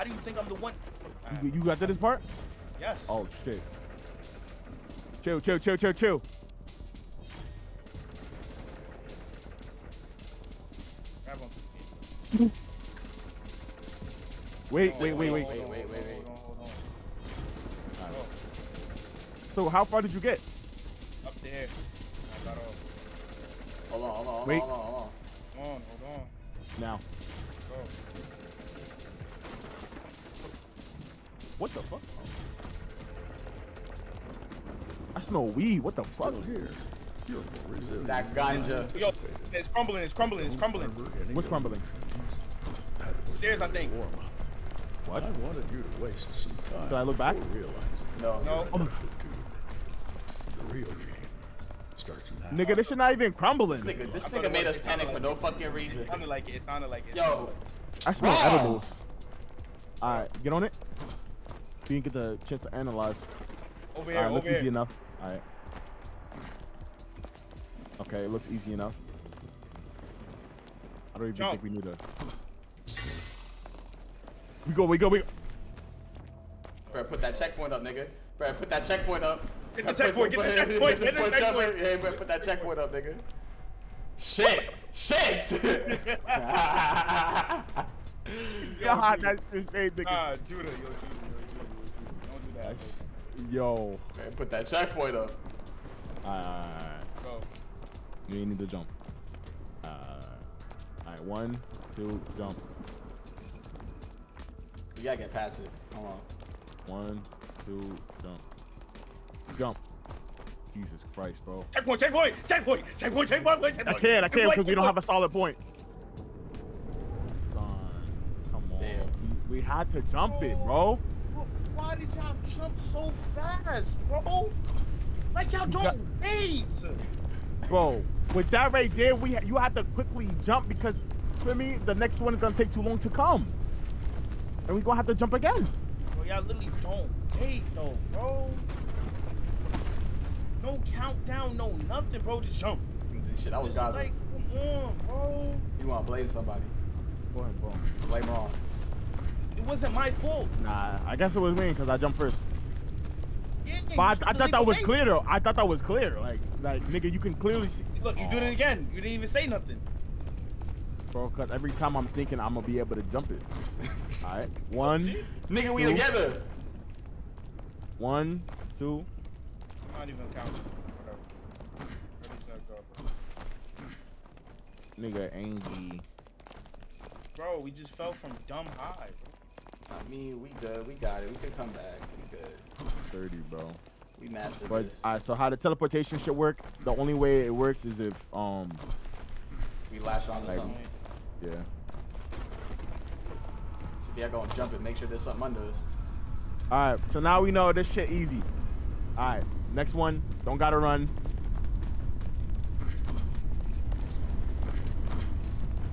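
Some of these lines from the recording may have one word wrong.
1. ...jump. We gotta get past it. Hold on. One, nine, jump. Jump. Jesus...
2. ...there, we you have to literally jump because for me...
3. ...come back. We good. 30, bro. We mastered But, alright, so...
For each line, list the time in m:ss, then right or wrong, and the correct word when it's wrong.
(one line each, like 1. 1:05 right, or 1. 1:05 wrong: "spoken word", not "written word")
1. 1:42 wrong: "two", not "nine"
2. 2:08 wrong: "quickly", not "literally"
3. 3:01 right.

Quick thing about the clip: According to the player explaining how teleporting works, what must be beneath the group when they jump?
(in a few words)
something under us.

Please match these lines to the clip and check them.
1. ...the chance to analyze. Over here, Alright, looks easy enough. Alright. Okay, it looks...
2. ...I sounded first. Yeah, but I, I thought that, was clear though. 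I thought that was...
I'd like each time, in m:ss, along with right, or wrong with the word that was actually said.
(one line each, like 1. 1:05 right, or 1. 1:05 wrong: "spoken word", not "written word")
1. 1:02 right
2. 2:31 wrong: "jumped", not "sounded".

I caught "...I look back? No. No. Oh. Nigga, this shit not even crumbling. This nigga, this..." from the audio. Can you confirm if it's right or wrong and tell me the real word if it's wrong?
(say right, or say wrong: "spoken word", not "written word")
right.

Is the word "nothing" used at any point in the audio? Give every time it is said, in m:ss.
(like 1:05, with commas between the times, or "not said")
2:21, 2:39.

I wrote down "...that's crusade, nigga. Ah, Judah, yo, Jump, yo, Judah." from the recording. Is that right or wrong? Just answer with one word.
wrong.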